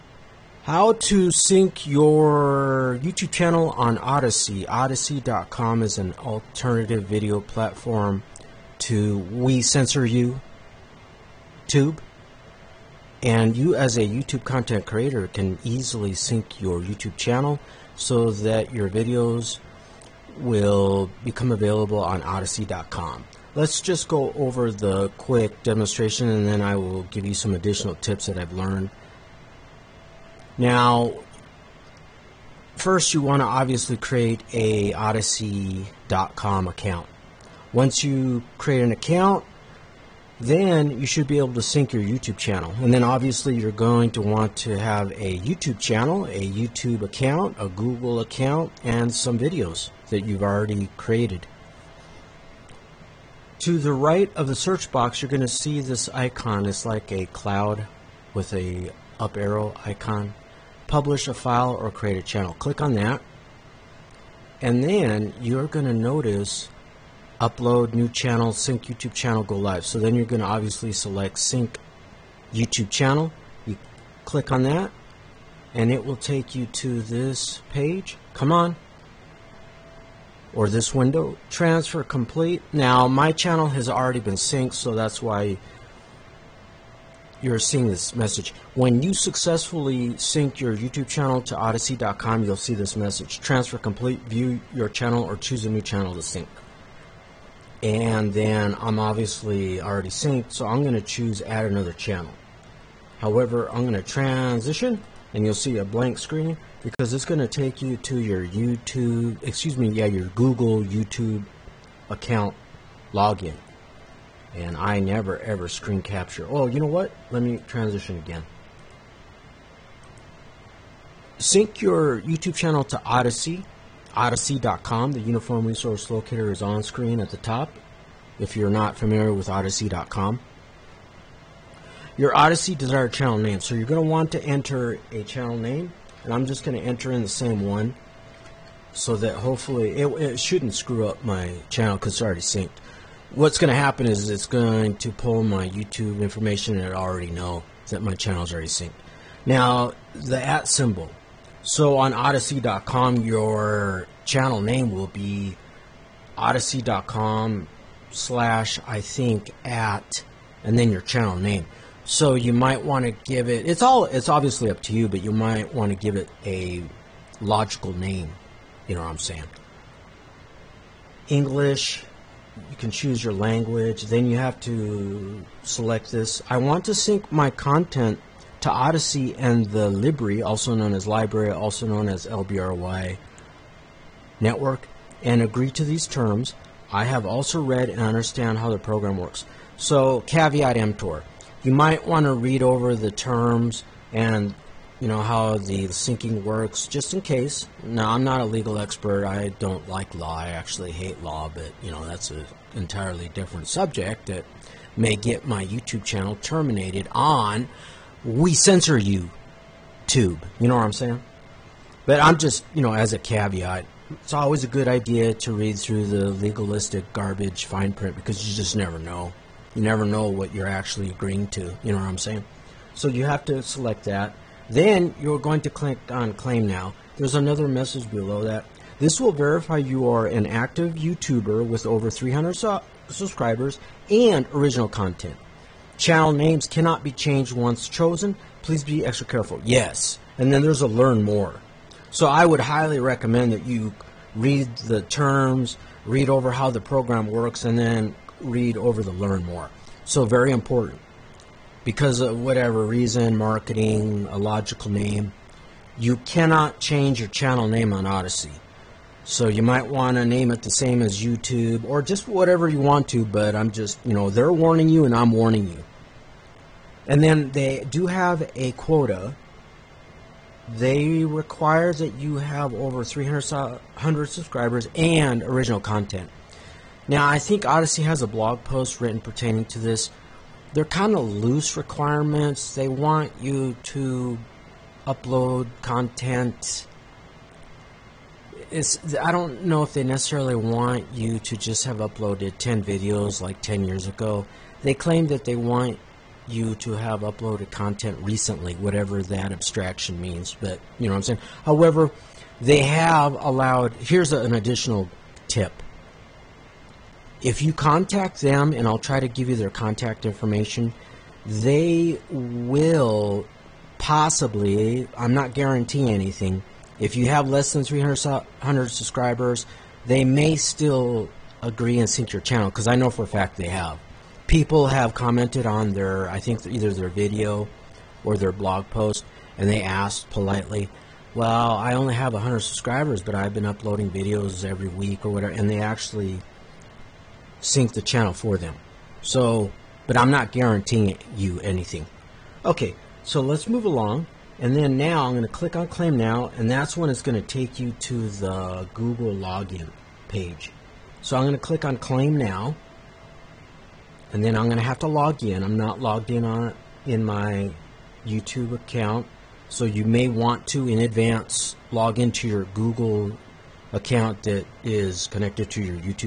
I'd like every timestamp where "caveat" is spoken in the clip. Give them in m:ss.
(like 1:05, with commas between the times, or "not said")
3:10, 3:33.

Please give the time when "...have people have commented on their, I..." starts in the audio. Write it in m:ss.
5:23.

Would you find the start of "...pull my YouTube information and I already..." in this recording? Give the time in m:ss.
2:25.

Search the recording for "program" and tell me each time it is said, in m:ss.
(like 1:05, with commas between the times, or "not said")
3:08, 4:06.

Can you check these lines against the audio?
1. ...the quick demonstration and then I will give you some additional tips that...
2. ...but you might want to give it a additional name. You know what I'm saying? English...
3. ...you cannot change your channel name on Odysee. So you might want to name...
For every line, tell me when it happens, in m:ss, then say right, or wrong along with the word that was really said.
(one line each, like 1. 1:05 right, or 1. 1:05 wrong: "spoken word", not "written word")
1. 0:24 right
2. 2:45 wrong: "logical", not "additional"
3. 4:15 right.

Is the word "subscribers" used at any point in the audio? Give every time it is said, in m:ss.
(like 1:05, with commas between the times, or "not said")
3:53, 4:34, 5:18, 5:32.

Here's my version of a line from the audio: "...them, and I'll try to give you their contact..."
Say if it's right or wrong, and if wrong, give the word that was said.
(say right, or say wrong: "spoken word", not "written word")
right.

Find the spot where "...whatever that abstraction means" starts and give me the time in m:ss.
4:58.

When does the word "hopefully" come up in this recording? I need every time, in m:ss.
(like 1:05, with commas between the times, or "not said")
2:19.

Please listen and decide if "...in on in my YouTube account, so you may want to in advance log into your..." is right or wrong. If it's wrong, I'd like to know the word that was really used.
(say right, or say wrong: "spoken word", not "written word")
right.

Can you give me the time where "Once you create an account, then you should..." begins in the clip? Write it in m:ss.
0:37.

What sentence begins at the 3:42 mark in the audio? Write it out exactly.
So you have to select that.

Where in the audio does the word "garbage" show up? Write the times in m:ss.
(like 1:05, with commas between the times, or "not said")
3:37.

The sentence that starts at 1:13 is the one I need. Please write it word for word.
You click on that and it will take you to this page.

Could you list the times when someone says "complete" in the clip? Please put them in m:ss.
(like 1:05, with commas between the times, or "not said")
1:22, 1:33.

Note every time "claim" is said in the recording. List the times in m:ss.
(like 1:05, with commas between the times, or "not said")
3:46, 4:54, 5:45, 5:51.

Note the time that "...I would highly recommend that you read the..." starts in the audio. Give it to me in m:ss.
4:02.